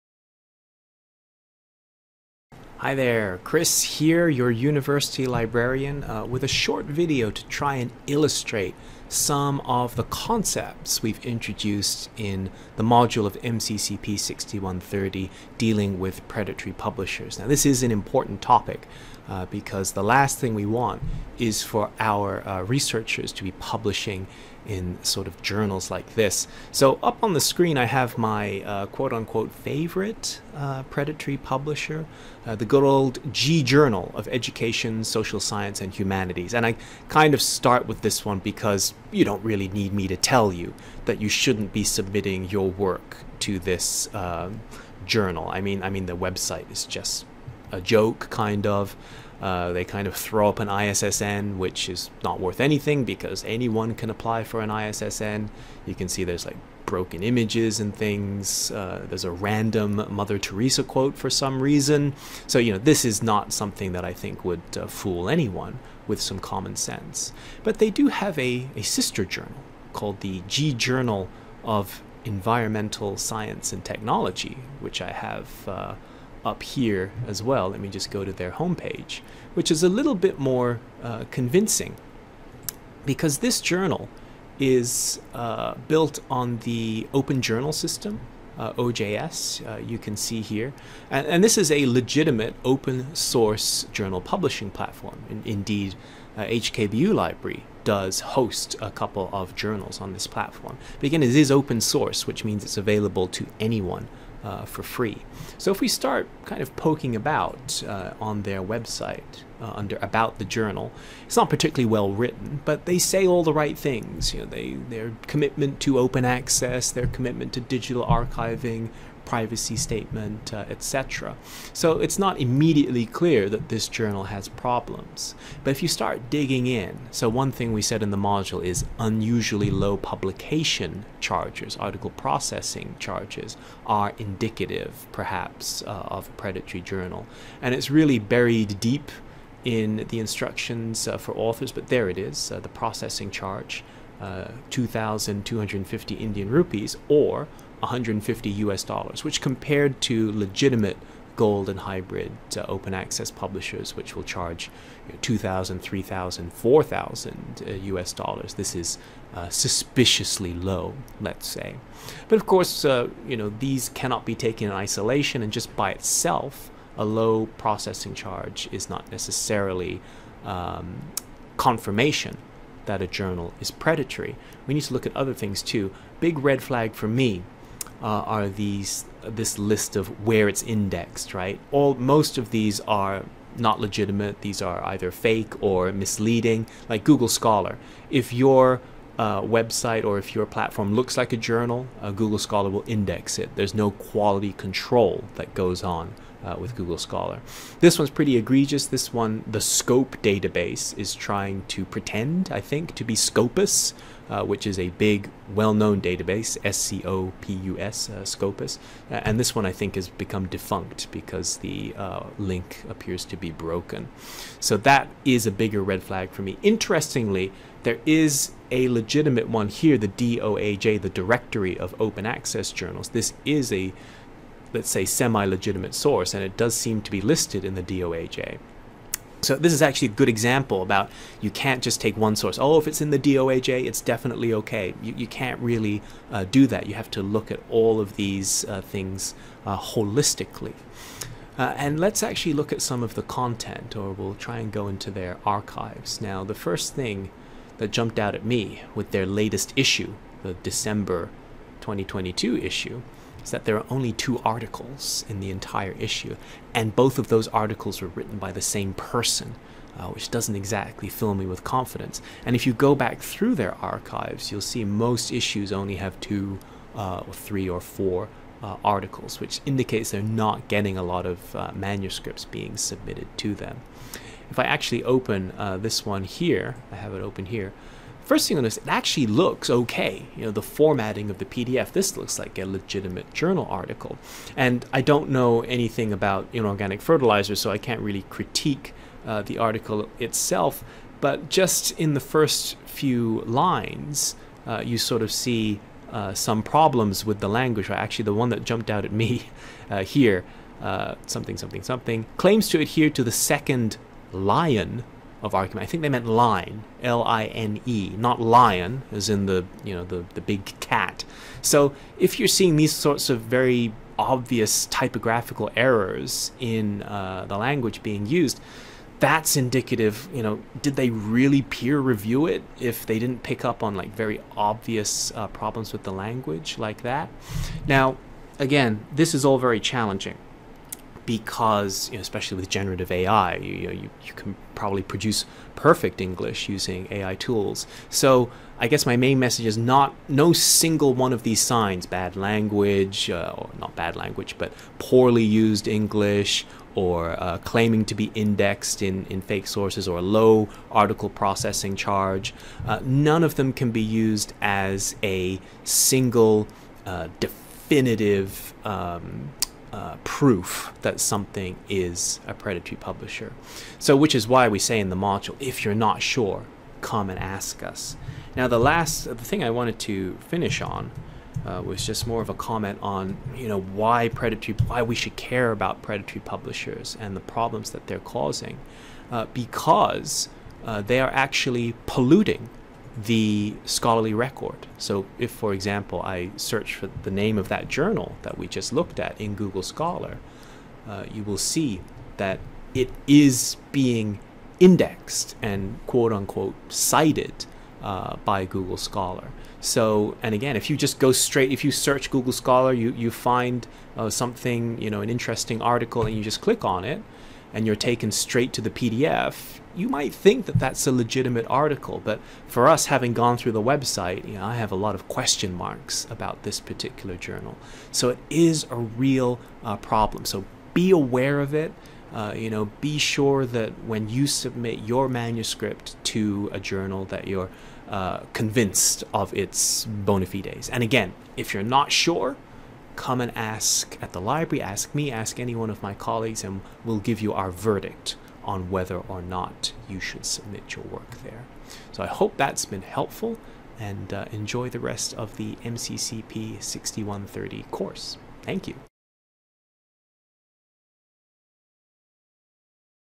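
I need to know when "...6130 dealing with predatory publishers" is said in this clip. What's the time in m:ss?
0:14.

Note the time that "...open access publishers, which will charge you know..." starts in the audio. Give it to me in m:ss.
2:32.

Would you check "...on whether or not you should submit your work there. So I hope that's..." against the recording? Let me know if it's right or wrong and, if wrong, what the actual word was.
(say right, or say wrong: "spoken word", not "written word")
right.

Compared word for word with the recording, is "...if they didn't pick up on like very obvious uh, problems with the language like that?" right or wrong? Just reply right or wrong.
right.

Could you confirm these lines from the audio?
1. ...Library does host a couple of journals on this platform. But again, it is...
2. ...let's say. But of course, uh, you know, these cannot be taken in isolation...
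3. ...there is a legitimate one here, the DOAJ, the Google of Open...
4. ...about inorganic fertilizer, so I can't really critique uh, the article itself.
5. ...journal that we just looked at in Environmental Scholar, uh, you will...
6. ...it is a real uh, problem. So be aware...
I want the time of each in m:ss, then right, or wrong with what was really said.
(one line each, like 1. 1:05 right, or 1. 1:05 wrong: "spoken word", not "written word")
1. 1:37 right
2. 2:41 right
3. 3:37 wrong: "Directory", not "Google"
4. 4:46 right
5. 6:27 wrong: "Google", not "Environmental"
6. 6:58 right.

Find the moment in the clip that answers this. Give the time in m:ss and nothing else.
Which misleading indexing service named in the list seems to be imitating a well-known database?
3:19.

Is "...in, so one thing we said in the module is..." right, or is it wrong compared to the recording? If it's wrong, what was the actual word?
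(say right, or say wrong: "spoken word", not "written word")
right.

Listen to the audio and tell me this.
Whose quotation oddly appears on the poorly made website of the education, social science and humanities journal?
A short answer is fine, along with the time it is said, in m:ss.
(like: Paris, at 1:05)
Mother Teresa, at 1:00.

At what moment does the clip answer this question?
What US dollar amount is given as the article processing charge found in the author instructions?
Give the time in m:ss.
2:27.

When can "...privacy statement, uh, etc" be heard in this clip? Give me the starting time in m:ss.
1:59.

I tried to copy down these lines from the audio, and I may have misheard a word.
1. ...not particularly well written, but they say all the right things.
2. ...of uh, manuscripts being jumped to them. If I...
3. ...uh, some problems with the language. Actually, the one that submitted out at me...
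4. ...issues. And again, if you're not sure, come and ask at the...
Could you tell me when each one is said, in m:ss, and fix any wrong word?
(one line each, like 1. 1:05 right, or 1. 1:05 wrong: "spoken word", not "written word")
1. 1:51 right
2. 4:31 wrong: "submitted", not "jumped"
3. 4:56 wrong: "jumped", not "submitted"
4. 7:10 wrong: "fides", not "issues".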